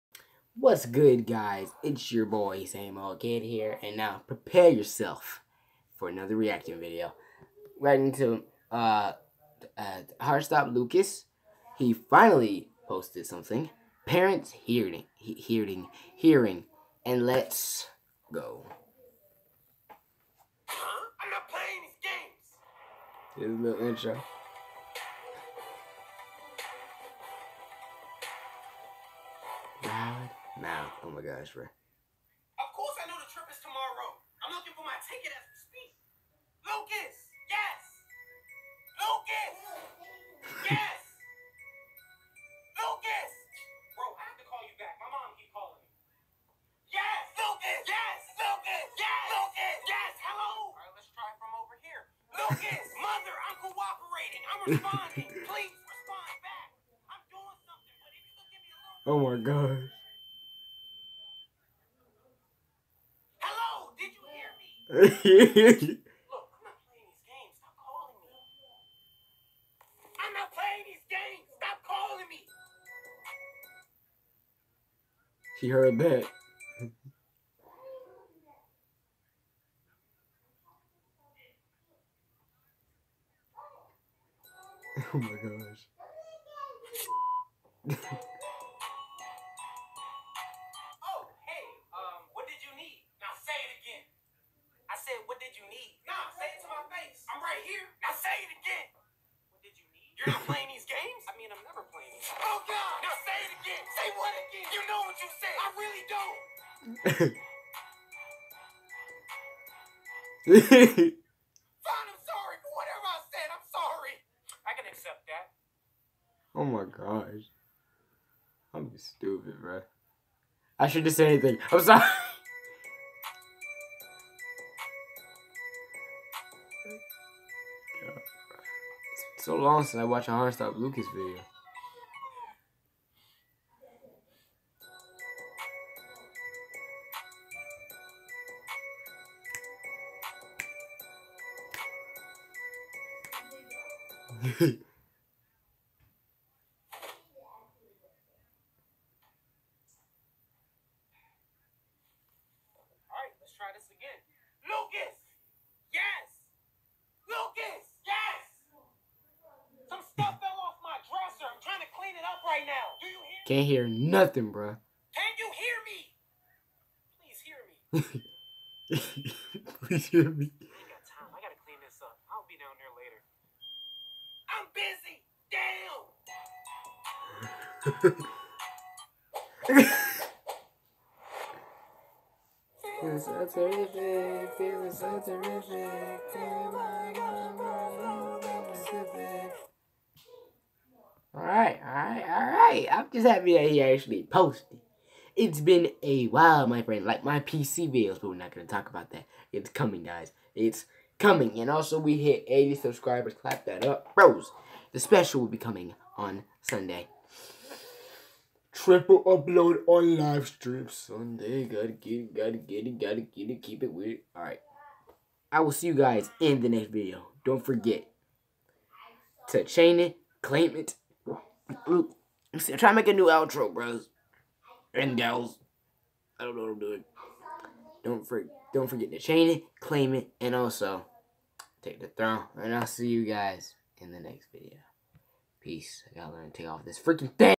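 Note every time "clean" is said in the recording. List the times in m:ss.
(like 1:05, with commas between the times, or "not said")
2:51.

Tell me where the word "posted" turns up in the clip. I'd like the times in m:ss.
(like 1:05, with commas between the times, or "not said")
0:12, 3:14.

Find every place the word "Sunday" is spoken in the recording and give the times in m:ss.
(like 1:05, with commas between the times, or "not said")
3:26, 3:30.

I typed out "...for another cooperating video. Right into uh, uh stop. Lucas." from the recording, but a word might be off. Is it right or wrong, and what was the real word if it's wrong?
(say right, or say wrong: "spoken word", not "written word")
wrong: "reacting", not "cooperating".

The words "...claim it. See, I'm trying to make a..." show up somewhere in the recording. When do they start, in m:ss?
3:40.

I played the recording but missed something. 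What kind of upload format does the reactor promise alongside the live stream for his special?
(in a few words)
Triple upload.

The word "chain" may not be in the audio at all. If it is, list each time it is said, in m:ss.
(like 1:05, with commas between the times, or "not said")
3:39, 3:49.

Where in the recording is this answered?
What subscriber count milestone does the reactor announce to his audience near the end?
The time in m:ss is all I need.
3:22.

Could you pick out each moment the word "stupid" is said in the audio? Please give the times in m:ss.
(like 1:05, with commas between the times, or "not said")
1:58.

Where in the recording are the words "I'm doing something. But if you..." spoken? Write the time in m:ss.
0:57.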